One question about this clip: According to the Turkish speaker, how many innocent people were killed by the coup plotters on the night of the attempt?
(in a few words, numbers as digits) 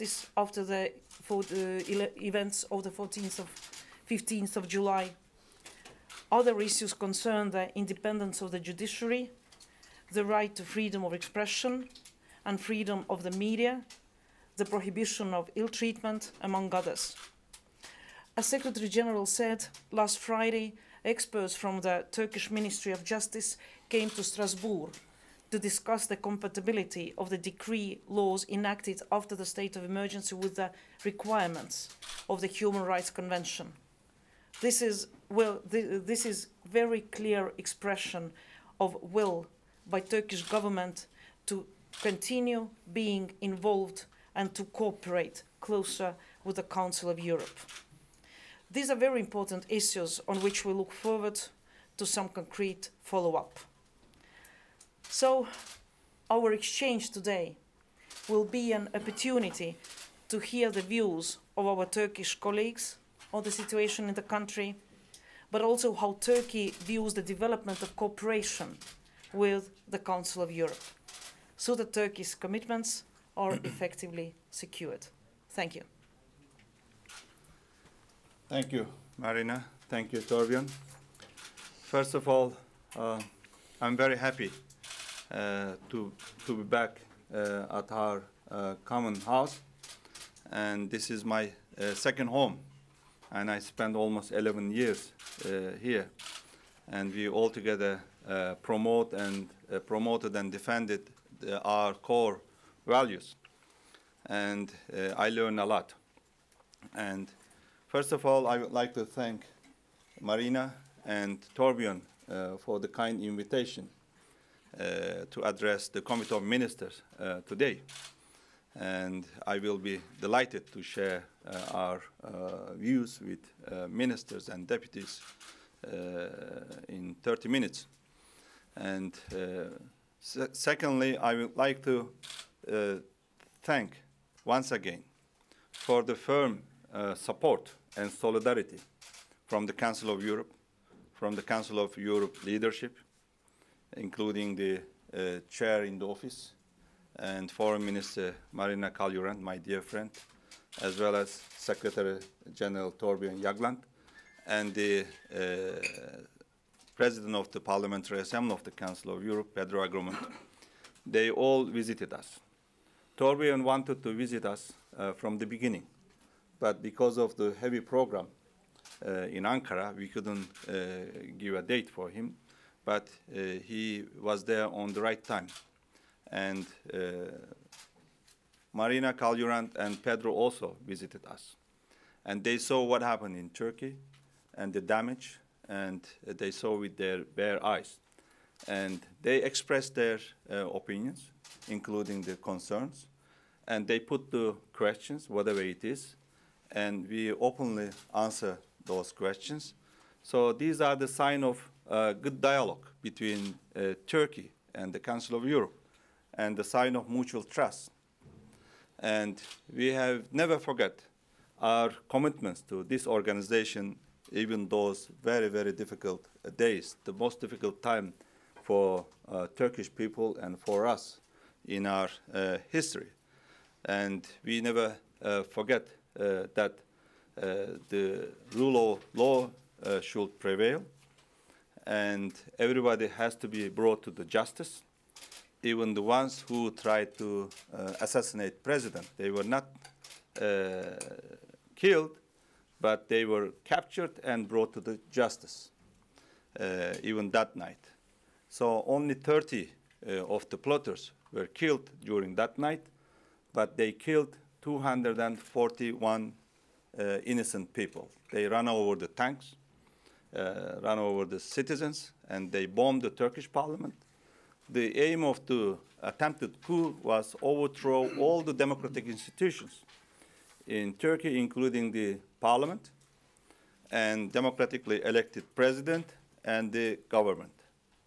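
241.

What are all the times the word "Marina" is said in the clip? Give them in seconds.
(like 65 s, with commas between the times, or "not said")
79 s, 110 s, 148 s, 178 s.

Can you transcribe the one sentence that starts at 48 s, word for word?
These are very important issues on which we look forward to some concrete follow-up.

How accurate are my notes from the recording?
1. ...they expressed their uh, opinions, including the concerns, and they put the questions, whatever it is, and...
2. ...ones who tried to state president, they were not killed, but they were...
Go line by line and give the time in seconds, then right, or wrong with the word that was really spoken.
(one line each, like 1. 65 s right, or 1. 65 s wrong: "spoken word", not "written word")
1. 189 s right
2. 236 s wrong: "assassinate", not "state".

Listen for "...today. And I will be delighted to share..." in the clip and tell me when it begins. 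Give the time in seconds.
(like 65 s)
117 s.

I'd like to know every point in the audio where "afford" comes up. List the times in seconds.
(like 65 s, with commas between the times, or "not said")
not said.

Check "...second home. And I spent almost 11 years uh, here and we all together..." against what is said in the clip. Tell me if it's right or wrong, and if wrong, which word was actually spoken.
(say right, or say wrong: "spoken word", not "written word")
right.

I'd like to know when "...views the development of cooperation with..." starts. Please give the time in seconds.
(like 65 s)
66 s.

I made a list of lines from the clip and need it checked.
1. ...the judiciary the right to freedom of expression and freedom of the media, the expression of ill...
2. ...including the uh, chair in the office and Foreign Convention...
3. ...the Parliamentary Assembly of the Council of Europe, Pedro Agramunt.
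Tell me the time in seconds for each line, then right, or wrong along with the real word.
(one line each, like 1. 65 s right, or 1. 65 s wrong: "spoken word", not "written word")
1. 8 s wrong: "prohibition", not "expression"
2. 143 s wrong: "Minister", not "Convention"
3. 157 s right.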